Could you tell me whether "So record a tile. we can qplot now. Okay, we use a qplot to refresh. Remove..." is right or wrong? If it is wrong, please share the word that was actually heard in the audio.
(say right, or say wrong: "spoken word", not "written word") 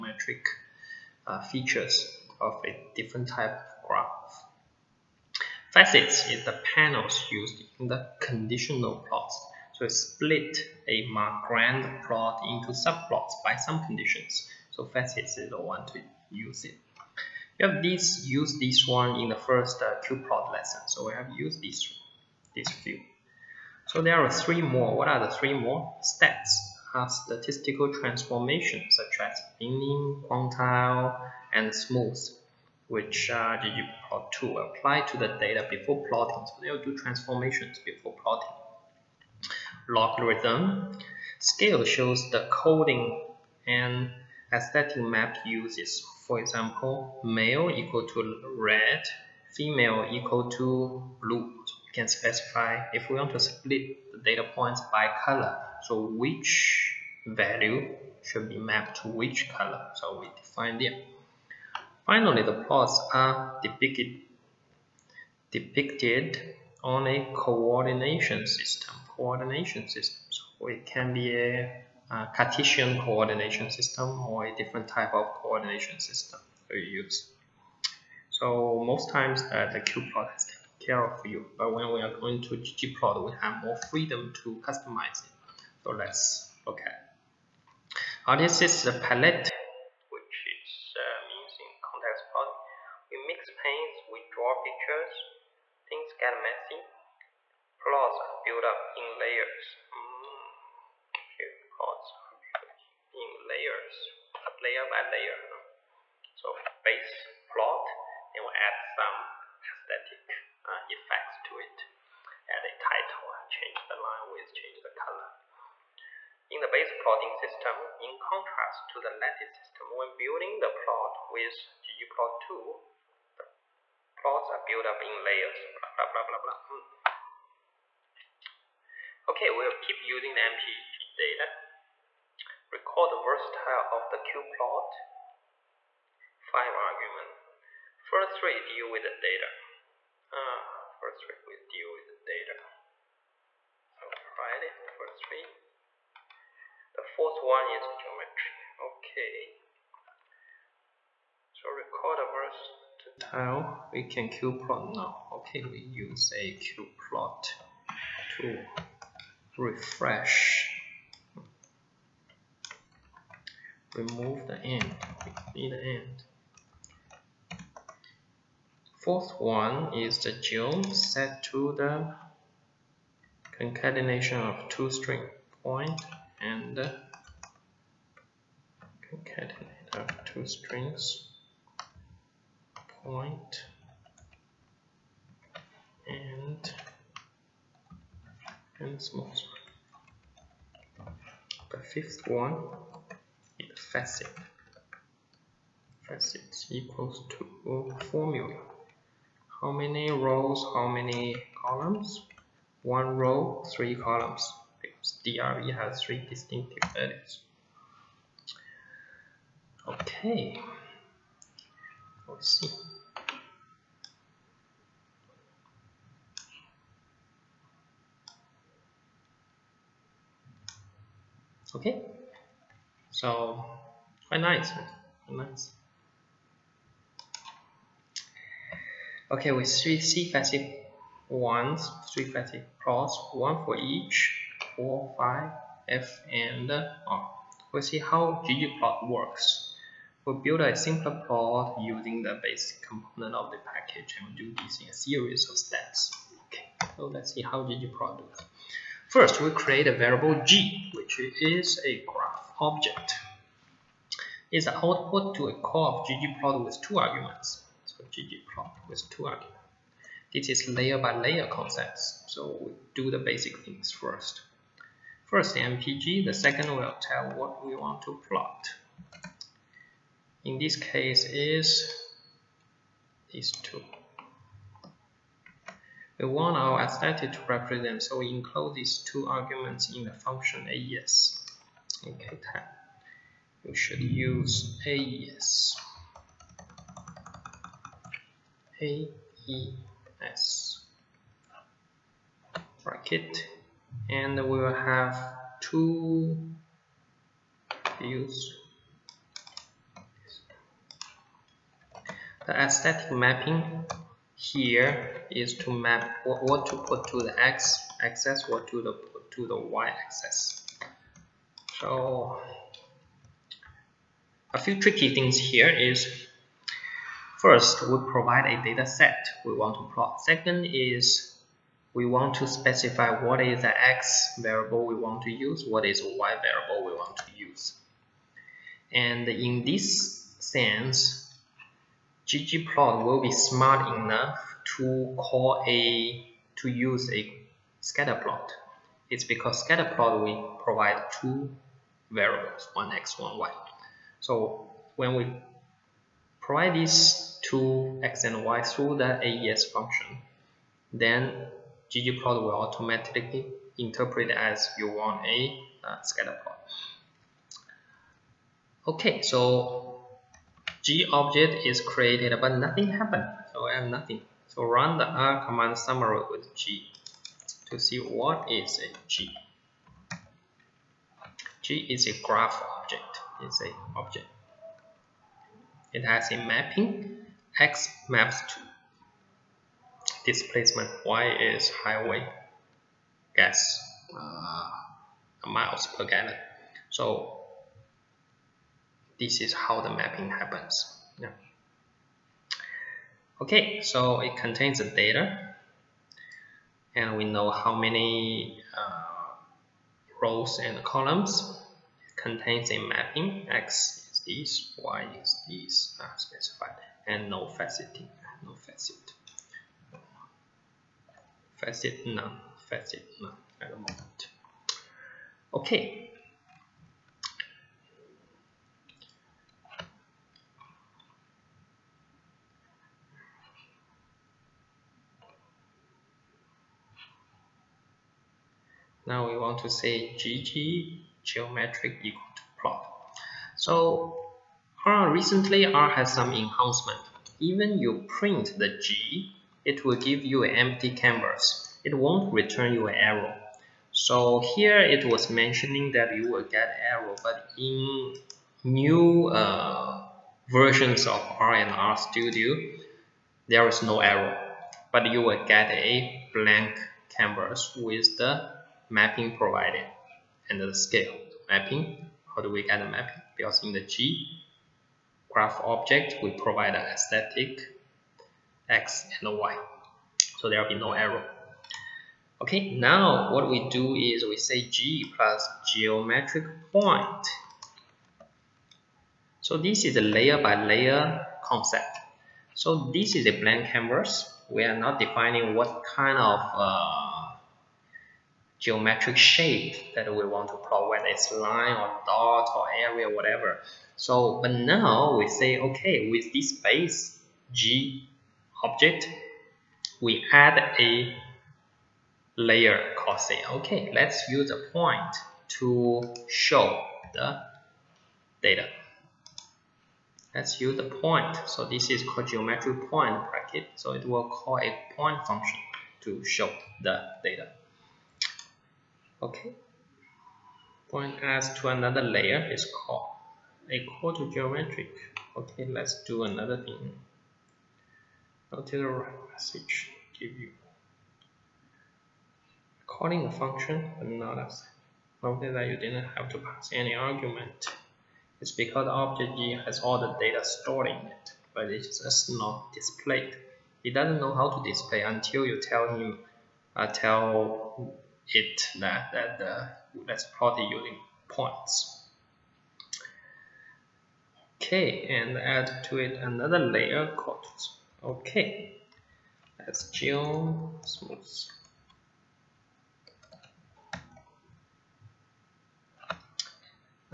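right.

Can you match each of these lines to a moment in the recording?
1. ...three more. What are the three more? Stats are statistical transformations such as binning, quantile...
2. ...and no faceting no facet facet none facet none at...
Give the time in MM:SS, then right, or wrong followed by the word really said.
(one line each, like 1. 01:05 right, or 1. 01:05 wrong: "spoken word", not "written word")
1. 00:24 right
2. 06:47 right.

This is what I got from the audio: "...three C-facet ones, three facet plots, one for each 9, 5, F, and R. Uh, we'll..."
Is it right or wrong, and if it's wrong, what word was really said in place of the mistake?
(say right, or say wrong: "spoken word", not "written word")
wrong: "4", not "9".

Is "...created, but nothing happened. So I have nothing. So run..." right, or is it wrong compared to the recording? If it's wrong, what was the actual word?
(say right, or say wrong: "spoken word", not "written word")
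right.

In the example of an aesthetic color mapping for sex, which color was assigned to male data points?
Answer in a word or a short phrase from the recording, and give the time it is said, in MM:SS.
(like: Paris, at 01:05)
Red, at 00:48.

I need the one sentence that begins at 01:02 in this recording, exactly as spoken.
Finally, the plots are depicted, on a coordination system.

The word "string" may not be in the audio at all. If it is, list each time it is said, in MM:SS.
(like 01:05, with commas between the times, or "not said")
02:54, 03:00.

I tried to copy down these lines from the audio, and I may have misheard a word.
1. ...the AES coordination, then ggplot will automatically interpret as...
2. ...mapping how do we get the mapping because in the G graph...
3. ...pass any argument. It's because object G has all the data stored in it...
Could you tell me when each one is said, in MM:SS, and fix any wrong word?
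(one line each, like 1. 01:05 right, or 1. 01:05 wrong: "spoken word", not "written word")
1. 05:48 wrong: "function", not "coordination"
2. 07:41 right
3. 08:56 right.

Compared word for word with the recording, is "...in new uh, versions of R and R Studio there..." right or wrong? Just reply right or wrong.
right.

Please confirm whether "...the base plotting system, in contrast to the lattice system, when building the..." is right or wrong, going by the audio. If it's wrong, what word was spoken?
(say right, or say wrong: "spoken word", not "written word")
right.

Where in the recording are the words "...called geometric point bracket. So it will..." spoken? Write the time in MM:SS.
08:32.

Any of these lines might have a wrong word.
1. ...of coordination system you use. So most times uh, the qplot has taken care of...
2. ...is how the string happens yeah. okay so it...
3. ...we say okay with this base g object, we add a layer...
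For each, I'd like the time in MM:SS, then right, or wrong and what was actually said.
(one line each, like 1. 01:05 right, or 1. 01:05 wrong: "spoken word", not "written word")
1. 01:15 right
2. 06:29 wrong: "mapping", not "string"
3. 08:15 right.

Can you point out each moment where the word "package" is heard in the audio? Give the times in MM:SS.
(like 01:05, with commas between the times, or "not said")
04:03.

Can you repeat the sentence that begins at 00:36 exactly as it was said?
So they'll do transformations before plotting.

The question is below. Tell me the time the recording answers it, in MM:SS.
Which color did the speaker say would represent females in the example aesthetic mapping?
00:51.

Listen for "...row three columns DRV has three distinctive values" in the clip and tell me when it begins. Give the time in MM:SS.
03:23.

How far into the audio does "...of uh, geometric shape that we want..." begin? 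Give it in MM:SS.
08:06.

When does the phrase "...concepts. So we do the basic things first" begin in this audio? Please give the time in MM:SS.
04:21.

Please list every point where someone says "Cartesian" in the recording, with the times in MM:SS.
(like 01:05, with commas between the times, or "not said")
01:12.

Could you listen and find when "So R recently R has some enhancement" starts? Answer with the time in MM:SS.
07:13.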